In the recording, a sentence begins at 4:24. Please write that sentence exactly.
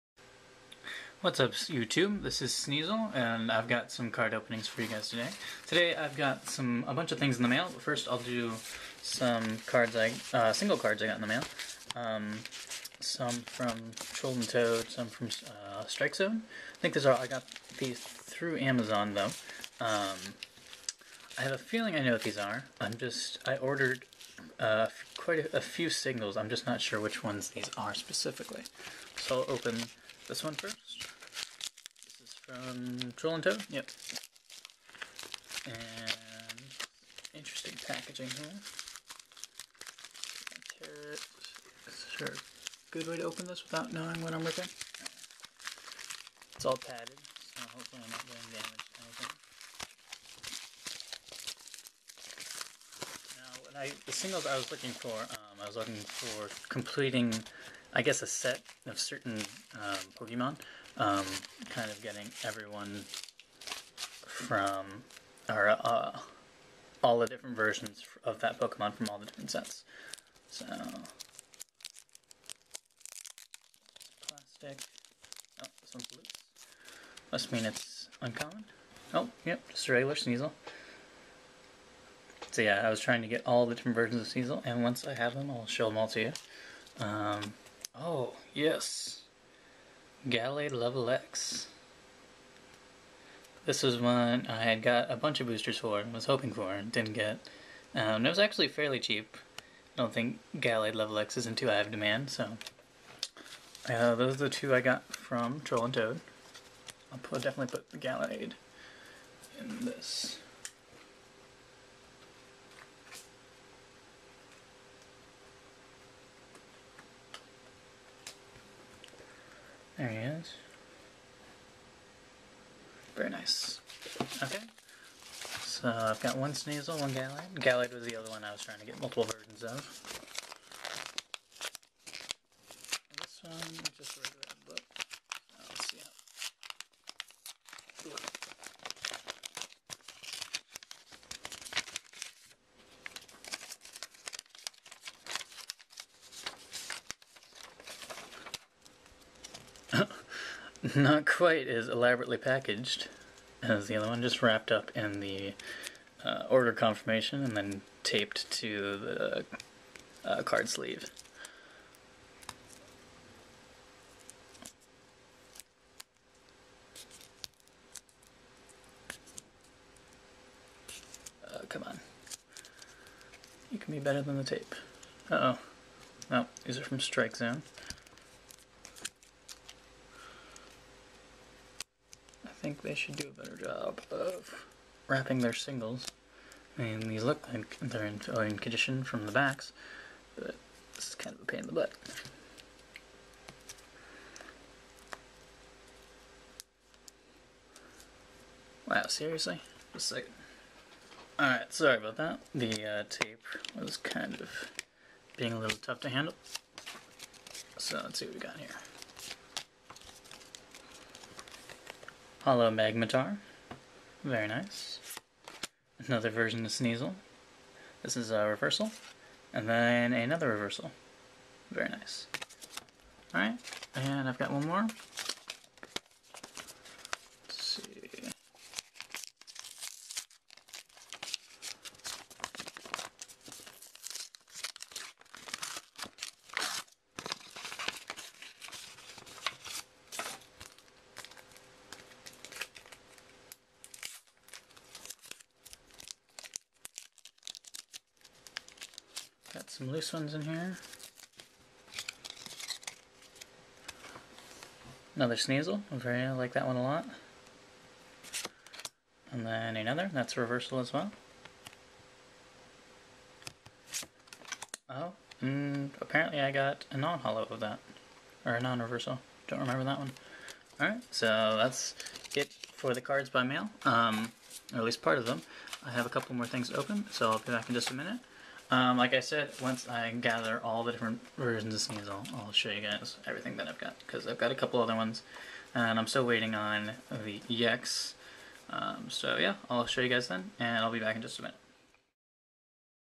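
Oh, and mm, apparently I got a non-holo of that.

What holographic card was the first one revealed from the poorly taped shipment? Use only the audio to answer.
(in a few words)
Holo Magmortar.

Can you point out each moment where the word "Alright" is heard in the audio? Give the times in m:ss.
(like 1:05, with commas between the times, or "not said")
3:21, 3:43, 4:30.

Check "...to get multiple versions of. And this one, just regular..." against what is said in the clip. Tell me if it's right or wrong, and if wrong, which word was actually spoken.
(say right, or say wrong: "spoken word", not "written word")
right.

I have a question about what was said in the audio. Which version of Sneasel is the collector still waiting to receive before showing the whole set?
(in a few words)
EX.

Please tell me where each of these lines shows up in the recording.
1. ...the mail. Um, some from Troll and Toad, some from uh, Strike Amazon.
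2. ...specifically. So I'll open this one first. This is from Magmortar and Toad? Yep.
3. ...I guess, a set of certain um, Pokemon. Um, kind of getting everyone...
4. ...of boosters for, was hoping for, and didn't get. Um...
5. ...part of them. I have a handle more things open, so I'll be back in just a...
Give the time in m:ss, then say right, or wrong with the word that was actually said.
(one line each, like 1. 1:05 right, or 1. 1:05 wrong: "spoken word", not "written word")
1. 0:11 wrong: "Zone", not "Amazon"
2. 0:27 wrong: "Troll", not "Magmortar"
3. 0:57 right
4. 1:35 right
5. 4:35 wrong: "couple", not "handle".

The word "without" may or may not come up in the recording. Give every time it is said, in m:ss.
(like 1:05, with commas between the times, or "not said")
0:43.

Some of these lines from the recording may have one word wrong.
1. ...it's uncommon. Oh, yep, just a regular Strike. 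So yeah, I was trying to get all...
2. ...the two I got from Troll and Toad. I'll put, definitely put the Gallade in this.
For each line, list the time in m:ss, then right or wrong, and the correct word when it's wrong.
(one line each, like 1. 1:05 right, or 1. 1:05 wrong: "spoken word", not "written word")
1. 1:17 wrong: "Sneasel", not "Strike"
2. 1:44 right.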